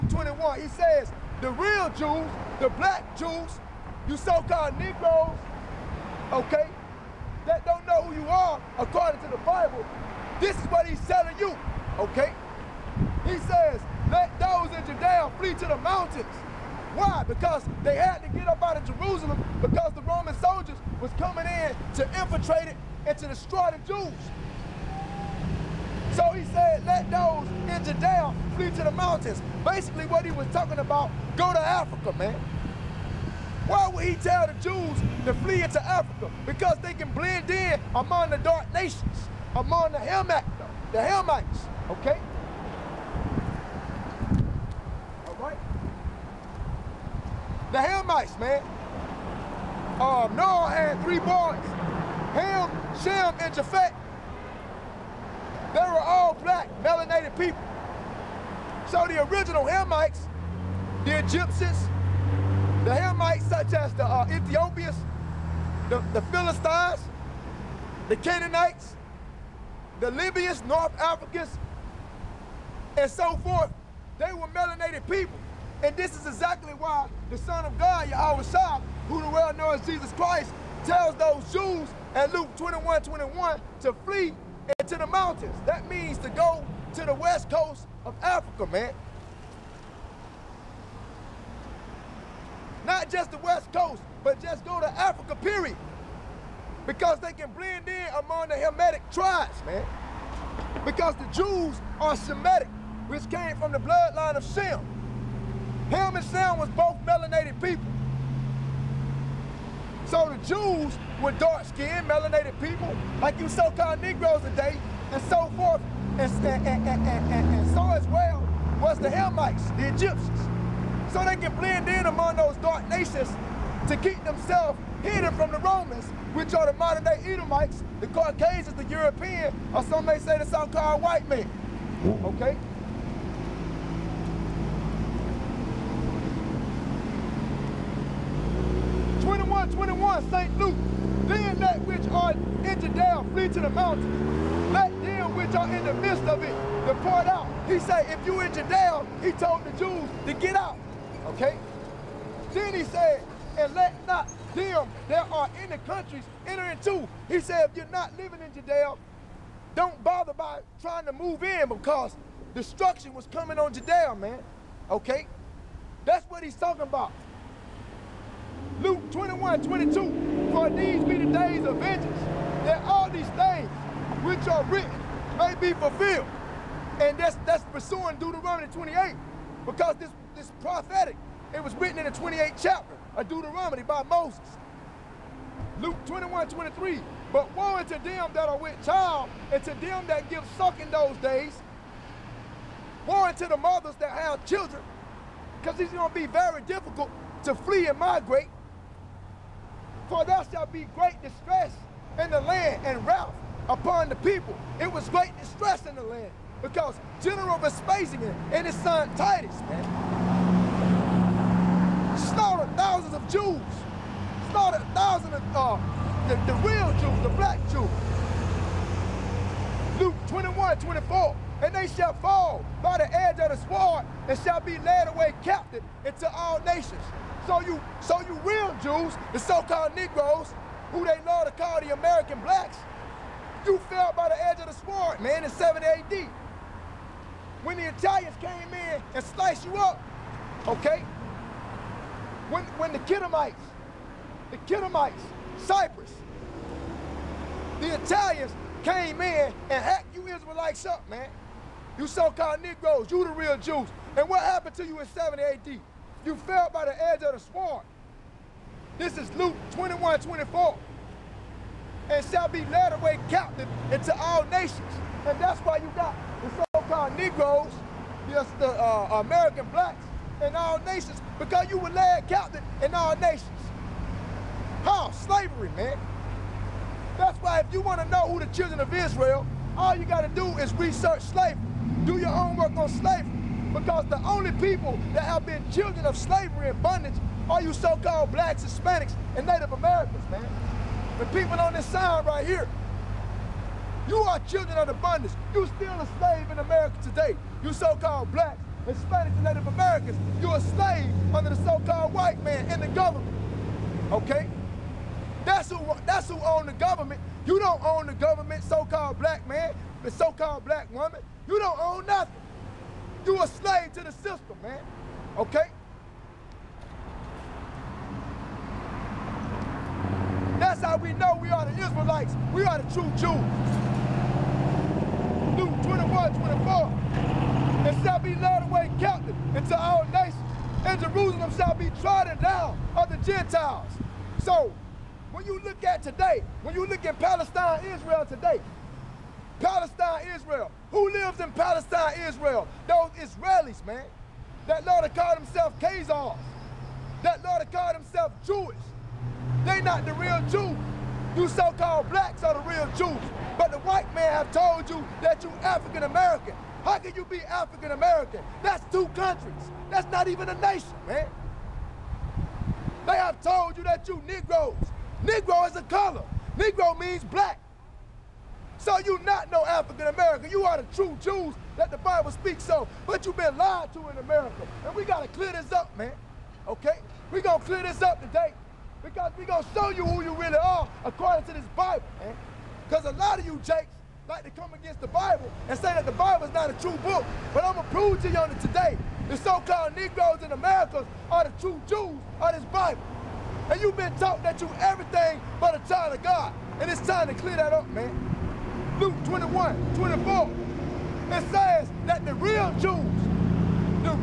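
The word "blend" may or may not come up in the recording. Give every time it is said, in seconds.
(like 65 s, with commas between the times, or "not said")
37 s, 97 s, 121 s.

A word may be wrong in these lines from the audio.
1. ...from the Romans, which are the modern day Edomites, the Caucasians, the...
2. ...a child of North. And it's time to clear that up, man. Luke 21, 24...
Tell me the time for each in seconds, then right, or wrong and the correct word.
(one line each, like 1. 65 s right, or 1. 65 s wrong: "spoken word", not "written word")
1. 125 s right
2. 395 s wrong: "God", not "North".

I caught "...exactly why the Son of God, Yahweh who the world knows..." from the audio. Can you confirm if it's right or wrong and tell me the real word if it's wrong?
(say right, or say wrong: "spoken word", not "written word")
right.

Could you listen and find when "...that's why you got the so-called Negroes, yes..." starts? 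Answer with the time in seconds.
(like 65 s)
265 s.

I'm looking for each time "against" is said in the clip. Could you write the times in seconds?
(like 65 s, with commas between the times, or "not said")
384 s.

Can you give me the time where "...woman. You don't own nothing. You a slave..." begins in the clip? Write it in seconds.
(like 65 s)
310 s.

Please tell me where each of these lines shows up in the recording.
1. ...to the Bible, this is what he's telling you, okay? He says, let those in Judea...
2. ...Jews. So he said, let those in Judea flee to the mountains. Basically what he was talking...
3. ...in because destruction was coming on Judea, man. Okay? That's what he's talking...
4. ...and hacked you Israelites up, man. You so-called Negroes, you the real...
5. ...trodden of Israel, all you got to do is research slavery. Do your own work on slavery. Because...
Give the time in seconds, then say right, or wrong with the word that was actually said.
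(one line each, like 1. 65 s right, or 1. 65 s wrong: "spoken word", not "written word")
1. 9 s right
2. 23 s right
3. 161 s right
4. 249 s right
5. 278 s wrong: "children", not "trodden".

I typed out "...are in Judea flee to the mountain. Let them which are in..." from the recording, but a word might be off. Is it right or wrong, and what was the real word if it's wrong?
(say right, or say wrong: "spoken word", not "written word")
right.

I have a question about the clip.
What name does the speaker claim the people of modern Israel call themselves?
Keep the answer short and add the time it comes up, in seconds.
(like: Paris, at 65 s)
Khazars, at 345 s.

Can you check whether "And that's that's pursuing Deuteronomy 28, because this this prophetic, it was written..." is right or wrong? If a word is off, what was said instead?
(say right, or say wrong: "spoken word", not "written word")
right.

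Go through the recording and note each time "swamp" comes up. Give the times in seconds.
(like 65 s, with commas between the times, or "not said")
257 s.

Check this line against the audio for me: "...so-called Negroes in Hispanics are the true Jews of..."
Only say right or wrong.
wrong.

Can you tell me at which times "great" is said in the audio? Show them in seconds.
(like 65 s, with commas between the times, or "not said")
200 s, 205 s.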